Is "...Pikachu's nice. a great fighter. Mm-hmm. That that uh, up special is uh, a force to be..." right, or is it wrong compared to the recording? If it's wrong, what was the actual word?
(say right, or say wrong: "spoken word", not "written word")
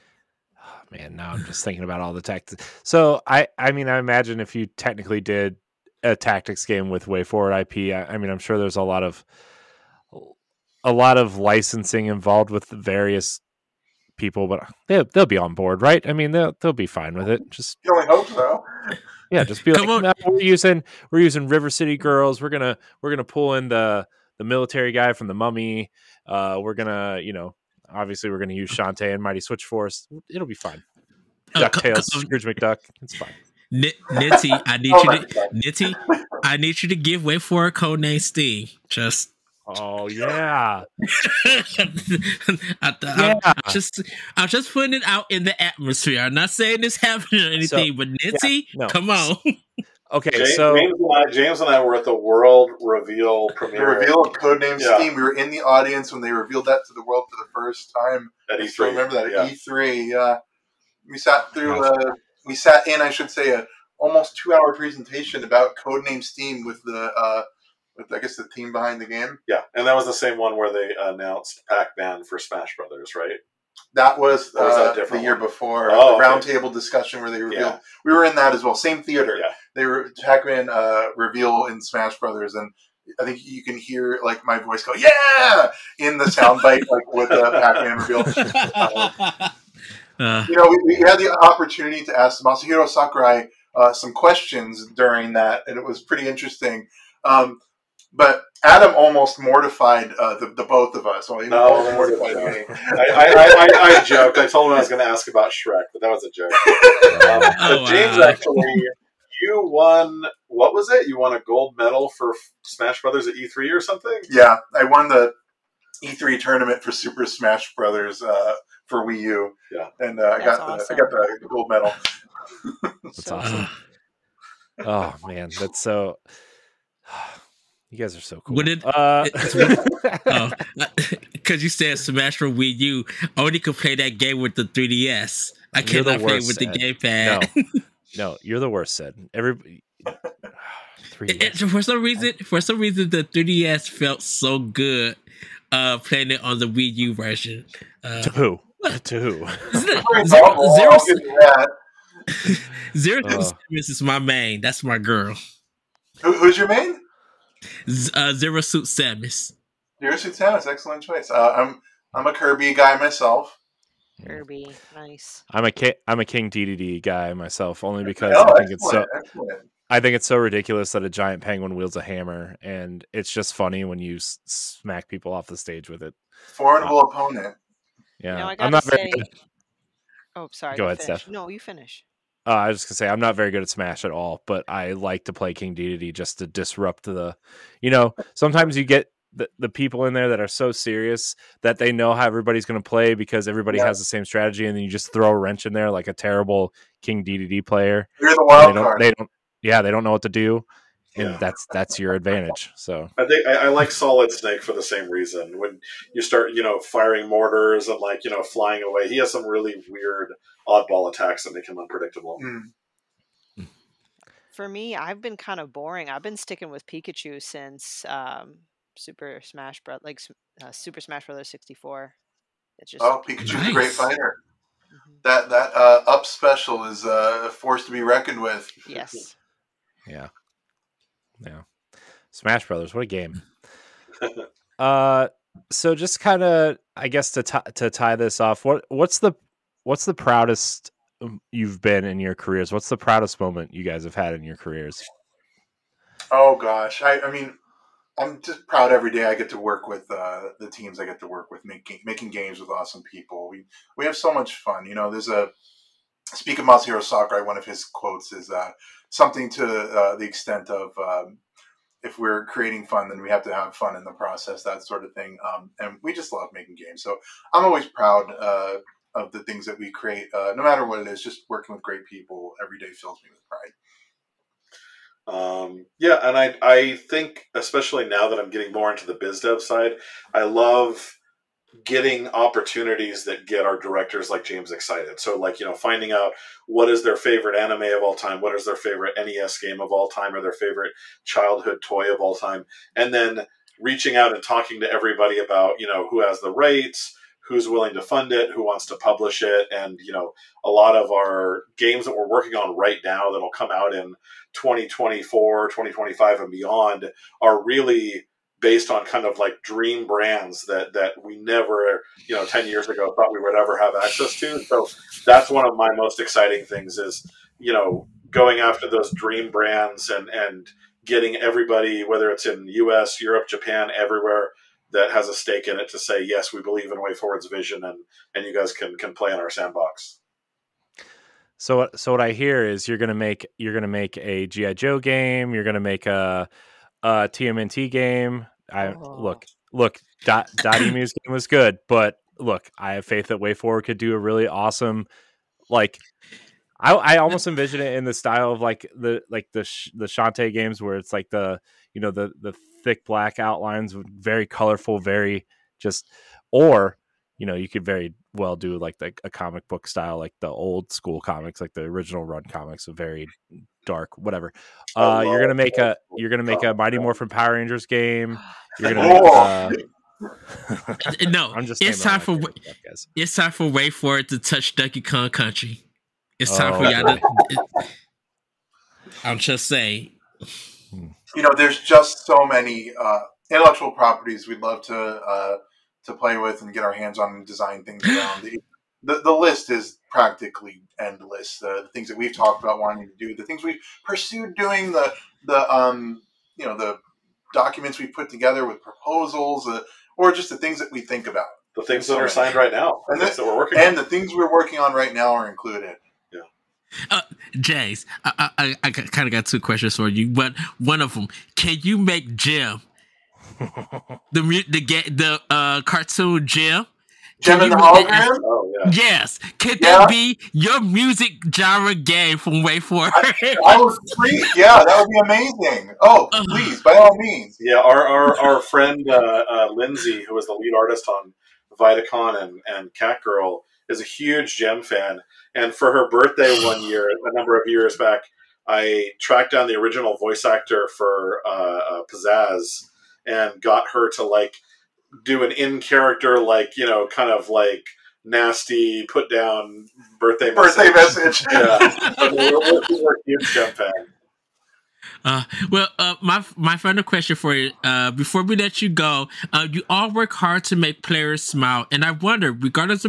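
right.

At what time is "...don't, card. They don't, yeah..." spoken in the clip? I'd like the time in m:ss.
3:18.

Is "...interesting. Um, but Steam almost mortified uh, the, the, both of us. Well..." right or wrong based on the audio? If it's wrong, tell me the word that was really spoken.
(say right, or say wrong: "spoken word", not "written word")
wrong: "Adam", not "Steam".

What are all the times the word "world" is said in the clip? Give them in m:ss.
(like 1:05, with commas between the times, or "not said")
0:52, 0:57.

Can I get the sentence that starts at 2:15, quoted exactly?
I you're cannot play with the gamepad.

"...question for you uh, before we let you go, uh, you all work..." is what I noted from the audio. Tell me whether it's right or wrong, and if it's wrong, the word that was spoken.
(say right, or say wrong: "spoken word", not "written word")
right.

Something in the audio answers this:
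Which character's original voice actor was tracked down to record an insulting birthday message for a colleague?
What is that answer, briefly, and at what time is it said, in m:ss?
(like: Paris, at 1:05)
Pizzazz, at 7:22.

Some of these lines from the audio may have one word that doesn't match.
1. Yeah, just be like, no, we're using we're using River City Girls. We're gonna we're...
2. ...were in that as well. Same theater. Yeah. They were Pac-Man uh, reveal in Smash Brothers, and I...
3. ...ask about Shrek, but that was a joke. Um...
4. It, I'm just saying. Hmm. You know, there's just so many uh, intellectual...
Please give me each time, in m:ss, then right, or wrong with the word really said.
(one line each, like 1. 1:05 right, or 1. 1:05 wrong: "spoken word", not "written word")
1. 0:19 right
2. 1:18 right
3. 1:45 right
4. 6:17 right.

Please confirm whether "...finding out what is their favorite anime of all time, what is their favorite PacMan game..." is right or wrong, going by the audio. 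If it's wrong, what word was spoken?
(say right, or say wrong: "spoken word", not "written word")
wrong: "NES", not "PacMan".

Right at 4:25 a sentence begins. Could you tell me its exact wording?
Um, and we just love making games.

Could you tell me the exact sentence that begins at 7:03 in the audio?
I, I was Yeah, that would be amazing.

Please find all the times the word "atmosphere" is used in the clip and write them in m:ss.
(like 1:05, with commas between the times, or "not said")
0:45.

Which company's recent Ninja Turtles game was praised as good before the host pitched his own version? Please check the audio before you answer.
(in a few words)
Dotemu.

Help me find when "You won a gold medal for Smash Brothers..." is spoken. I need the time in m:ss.
1:51.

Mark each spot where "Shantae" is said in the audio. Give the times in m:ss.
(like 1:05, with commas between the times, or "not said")
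0:28, 5:50.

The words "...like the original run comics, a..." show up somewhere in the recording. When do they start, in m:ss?
6:01.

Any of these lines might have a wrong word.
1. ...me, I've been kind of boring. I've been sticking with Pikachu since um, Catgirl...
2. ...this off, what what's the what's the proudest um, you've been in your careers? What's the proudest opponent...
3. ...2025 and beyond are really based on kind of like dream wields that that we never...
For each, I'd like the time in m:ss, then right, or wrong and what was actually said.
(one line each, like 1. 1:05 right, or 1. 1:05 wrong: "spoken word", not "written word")
1. 3:34 wrong: "Super", not "Catgirl"
2. 3:58 wrong: "moment", not "opponent"
3. 5:05 wrong: "brands", not "wields".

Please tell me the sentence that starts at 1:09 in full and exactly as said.
Yeah, and that was the same one where they announced Pac-Man for Smash Brothers, right?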